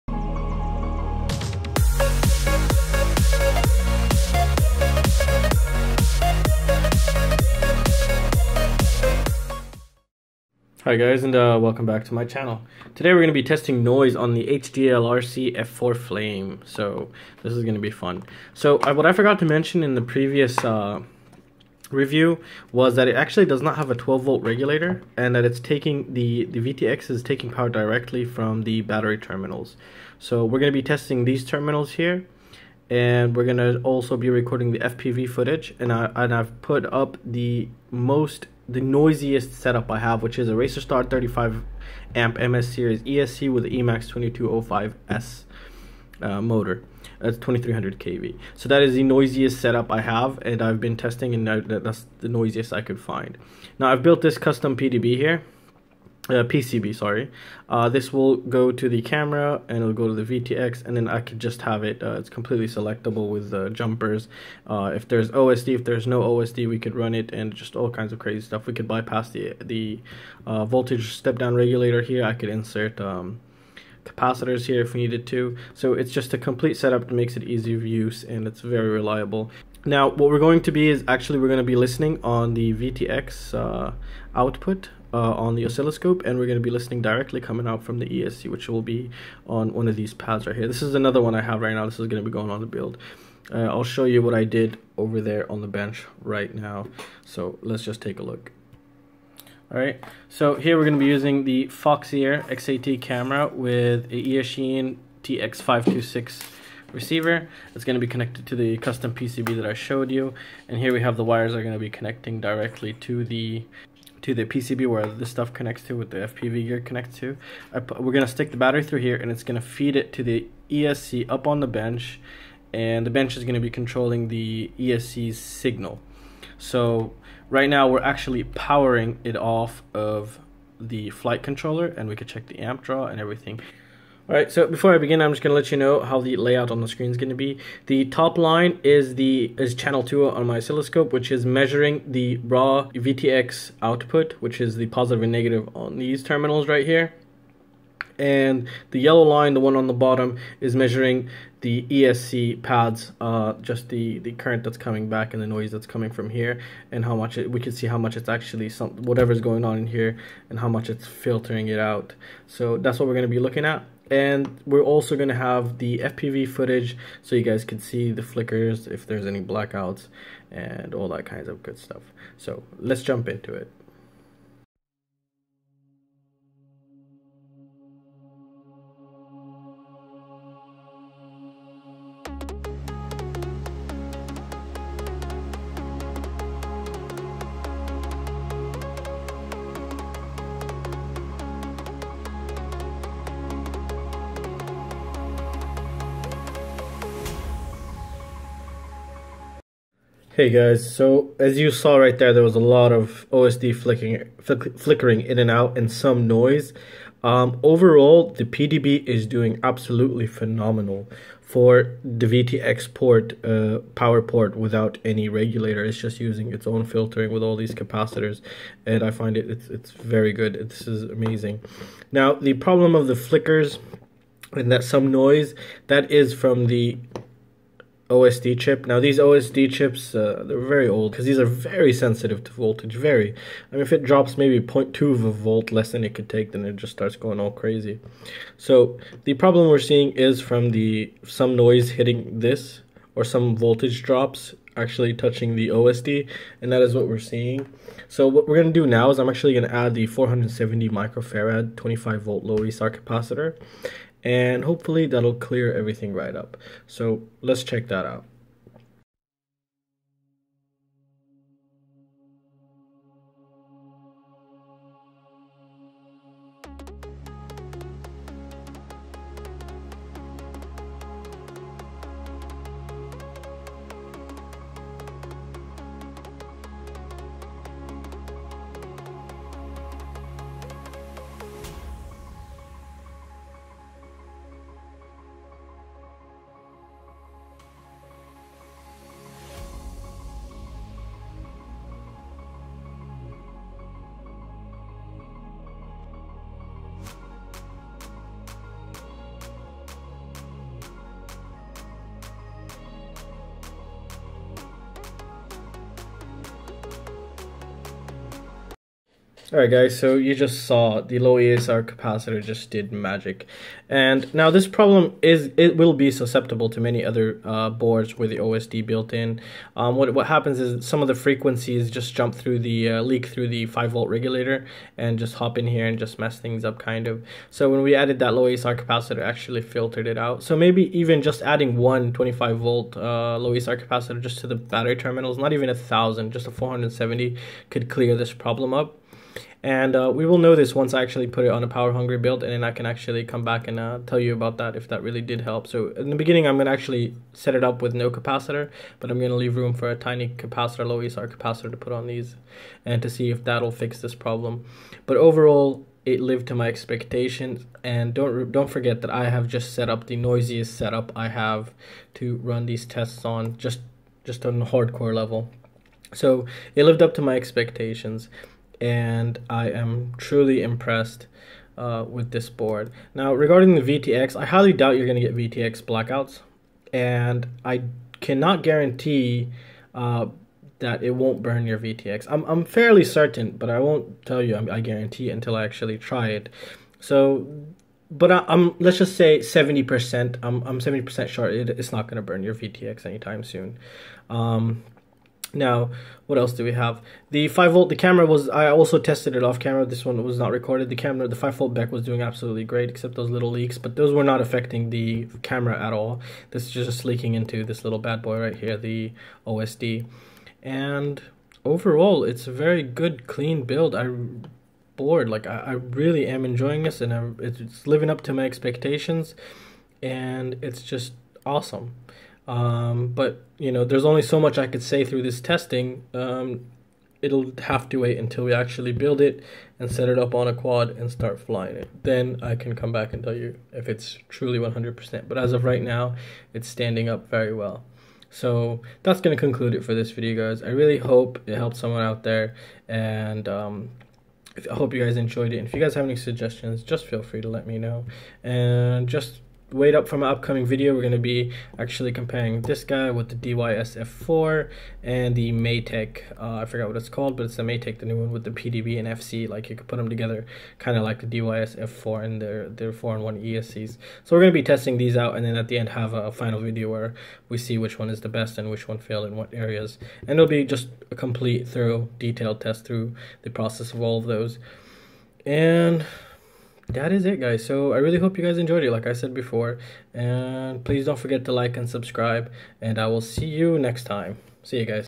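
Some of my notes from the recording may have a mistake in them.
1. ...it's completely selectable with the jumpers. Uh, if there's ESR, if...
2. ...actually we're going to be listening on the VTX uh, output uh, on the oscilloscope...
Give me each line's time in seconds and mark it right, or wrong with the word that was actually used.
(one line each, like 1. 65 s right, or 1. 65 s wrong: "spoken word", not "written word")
1. 62 s wrong: "OSD", not "ESR"
2. 81 s right.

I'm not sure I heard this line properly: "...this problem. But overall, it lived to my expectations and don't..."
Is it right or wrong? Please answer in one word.
right.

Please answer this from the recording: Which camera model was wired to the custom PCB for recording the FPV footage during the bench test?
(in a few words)
Foxeer XAT.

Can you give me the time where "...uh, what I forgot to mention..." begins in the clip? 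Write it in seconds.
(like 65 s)
18 s.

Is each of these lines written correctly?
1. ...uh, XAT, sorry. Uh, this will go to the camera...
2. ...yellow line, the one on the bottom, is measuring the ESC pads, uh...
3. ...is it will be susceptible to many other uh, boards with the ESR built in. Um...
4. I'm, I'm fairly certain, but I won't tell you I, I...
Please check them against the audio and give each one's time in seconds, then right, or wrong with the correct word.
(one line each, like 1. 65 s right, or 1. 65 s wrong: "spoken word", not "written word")
1. 56 s wrong: "PCB", not "XAT"
2. 148 s right
3. 315 s wrong: "OSD", not "ESR"
4. 382 s right.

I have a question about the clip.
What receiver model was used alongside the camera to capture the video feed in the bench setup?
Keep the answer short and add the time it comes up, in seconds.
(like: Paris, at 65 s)
Eachine TX526, at 104 s.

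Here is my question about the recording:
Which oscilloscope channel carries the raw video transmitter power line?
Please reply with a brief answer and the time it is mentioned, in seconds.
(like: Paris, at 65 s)
channel 2, at 139 s.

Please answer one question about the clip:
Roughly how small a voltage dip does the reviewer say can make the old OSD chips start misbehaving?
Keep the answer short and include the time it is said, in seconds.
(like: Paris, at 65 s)
0.2 volt, at 234 s.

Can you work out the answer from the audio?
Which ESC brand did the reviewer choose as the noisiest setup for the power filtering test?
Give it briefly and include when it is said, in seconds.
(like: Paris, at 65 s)
Racerstar, at 40 s.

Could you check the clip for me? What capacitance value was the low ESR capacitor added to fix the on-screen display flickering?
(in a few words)
470 microfarad.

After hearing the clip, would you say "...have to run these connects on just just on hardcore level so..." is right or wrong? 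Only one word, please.
wrong.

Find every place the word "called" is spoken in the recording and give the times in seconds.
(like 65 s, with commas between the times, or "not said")
457 s.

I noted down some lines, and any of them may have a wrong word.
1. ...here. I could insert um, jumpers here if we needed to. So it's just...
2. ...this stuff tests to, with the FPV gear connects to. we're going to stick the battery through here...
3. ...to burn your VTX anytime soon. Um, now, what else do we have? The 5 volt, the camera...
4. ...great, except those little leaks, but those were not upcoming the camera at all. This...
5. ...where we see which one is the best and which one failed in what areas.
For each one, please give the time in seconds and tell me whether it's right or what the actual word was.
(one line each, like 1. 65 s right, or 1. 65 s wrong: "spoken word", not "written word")
1. 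72 s wrong: "capacitors", not "jumpers"
2. 115 s wrong: "connects", not "tests"
3. 392 s right
4. 402 s wrong: "affecting", not "upcoming"
5. 466 s right.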